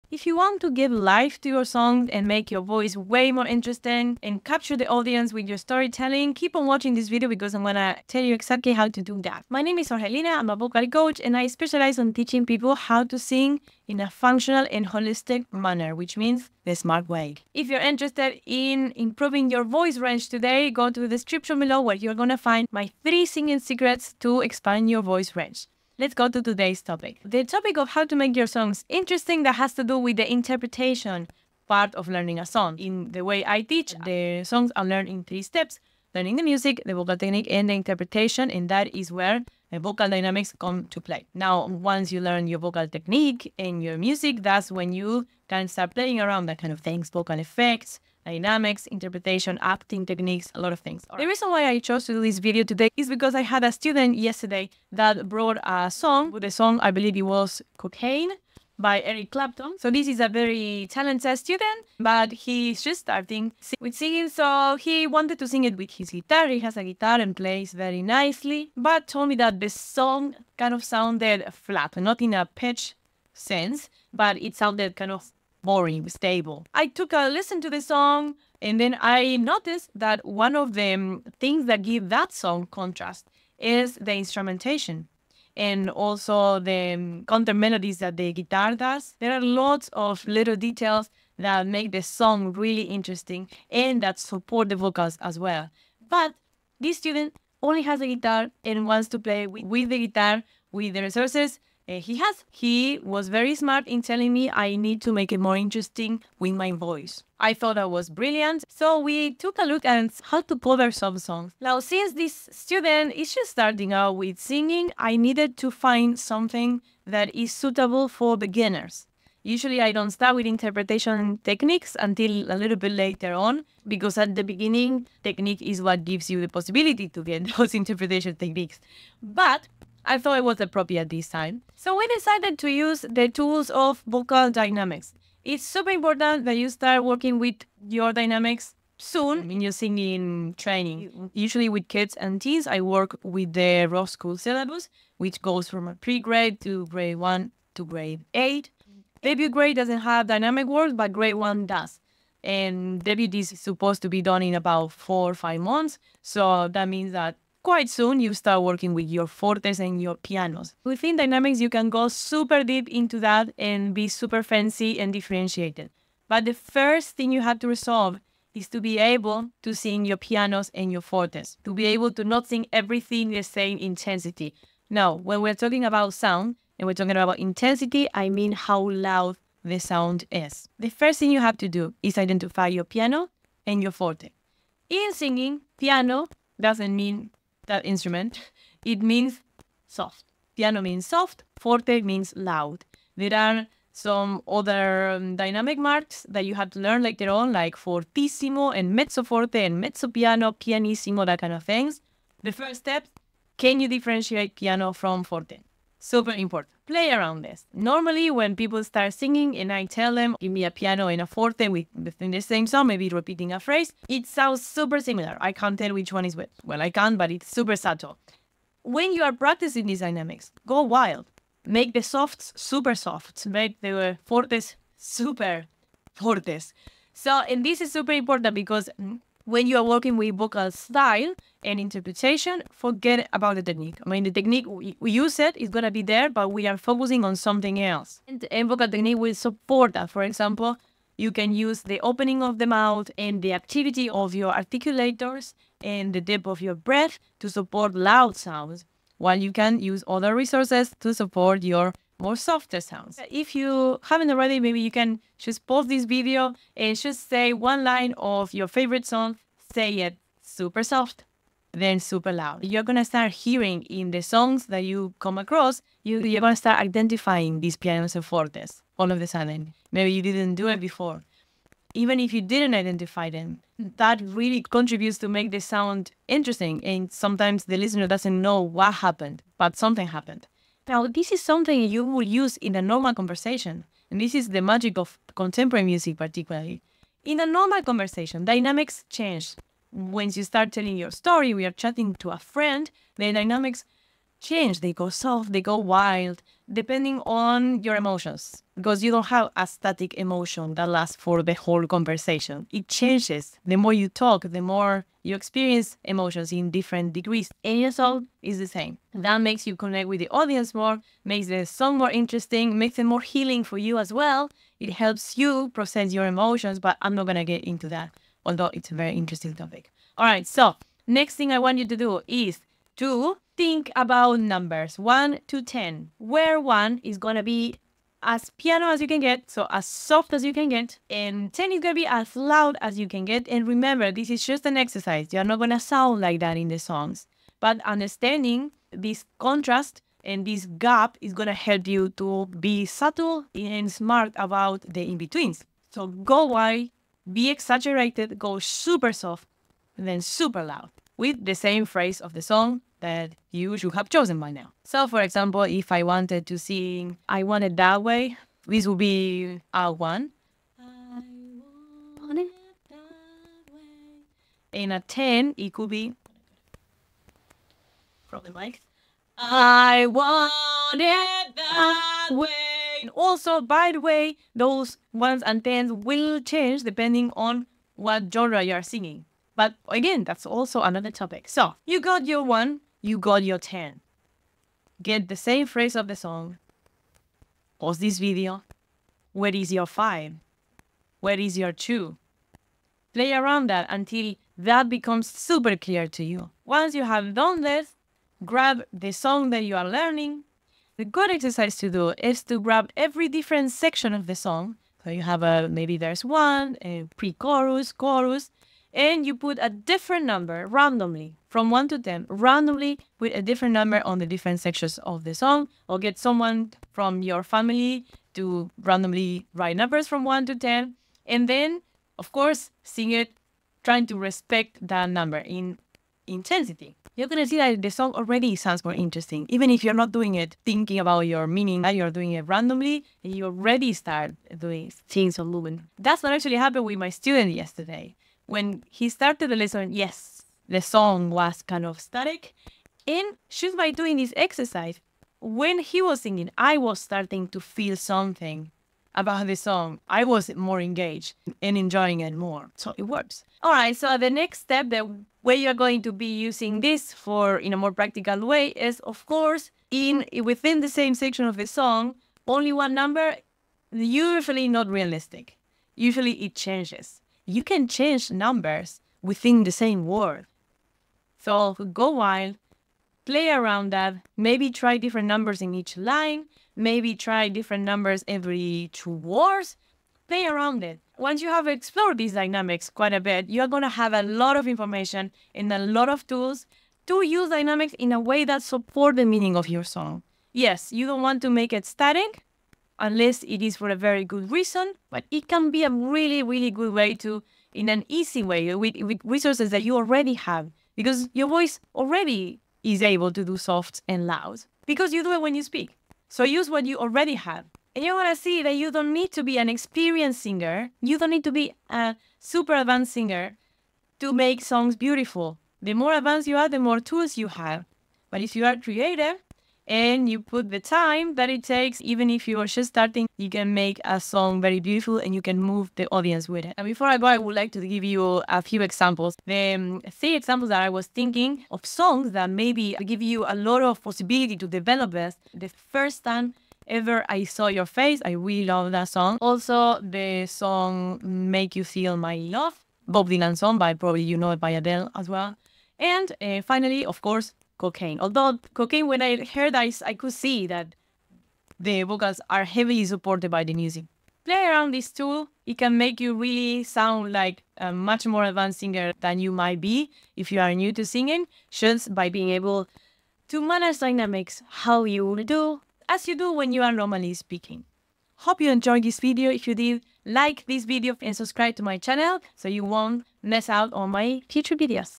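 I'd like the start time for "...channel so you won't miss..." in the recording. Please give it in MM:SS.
09:31.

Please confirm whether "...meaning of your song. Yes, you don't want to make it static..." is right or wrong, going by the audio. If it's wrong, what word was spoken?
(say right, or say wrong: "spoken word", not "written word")
right.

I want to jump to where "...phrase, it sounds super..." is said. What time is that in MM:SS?
03:33.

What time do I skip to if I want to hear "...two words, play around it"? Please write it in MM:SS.
07:58.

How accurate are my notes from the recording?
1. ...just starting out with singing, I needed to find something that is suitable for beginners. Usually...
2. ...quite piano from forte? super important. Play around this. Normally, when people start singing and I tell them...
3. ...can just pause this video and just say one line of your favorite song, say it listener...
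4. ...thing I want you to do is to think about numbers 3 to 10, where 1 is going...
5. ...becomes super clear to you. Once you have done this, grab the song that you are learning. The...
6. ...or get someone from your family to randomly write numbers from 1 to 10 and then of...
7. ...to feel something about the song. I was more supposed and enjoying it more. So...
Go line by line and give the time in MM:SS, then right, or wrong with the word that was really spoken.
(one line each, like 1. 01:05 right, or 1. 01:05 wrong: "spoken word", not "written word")
1. 01:53 right
2. 03:23 wrong: "differentiate", not "quite"
3. 04:14 wrong: "super", not "listener"
4. 05:21 wrong: "1", not "3"
5. 06:34 right
6. 06:55 right
7. 07:27 wrong: "engaged", not "supposed".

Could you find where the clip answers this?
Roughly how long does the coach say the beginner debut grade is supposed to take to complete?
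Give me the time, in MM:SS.
02:34.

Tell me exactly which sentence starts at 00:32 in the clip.
In the way I teach, the songs are learned in three steps.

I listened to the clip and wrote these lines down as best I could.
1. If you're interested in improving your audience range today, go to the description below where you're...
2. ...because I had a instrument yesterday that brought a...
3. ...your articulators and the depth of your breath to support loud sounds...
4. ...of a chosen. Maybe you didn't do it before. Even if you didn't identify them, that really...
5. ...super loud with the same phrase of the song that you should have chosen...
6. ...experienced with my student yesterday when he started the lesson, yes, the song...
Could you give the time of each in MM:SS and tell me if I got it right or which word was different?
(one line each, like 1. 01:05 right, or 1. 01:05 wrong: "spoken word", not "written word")
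1. 00:17 wrong: "voice", not "audience"
2. 00:53 wrong: "student", not "instrument"
3. 04:04 right
4. 04:29 wrong: "sudden", not "chosen"
5. 05:50 right
6. 07:16 wrong: "happened", not "experienced".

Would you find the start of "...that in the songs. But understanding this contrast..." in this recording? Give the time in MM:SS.
05:36.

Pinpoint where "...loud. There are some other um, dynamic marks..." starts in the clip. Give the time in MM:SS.
03:12.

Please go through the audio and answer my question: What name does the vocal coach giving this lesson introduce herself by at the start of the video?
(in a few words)
Jorgelina.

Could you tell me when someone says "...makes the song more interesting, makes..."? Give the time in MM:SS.
05:11.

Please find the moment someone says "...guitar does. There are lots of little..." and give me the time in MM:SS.
01:28.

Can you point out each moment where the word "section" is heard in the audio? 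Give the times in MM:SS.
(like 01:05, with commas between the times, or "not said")
06:43, 06:54, 07:41.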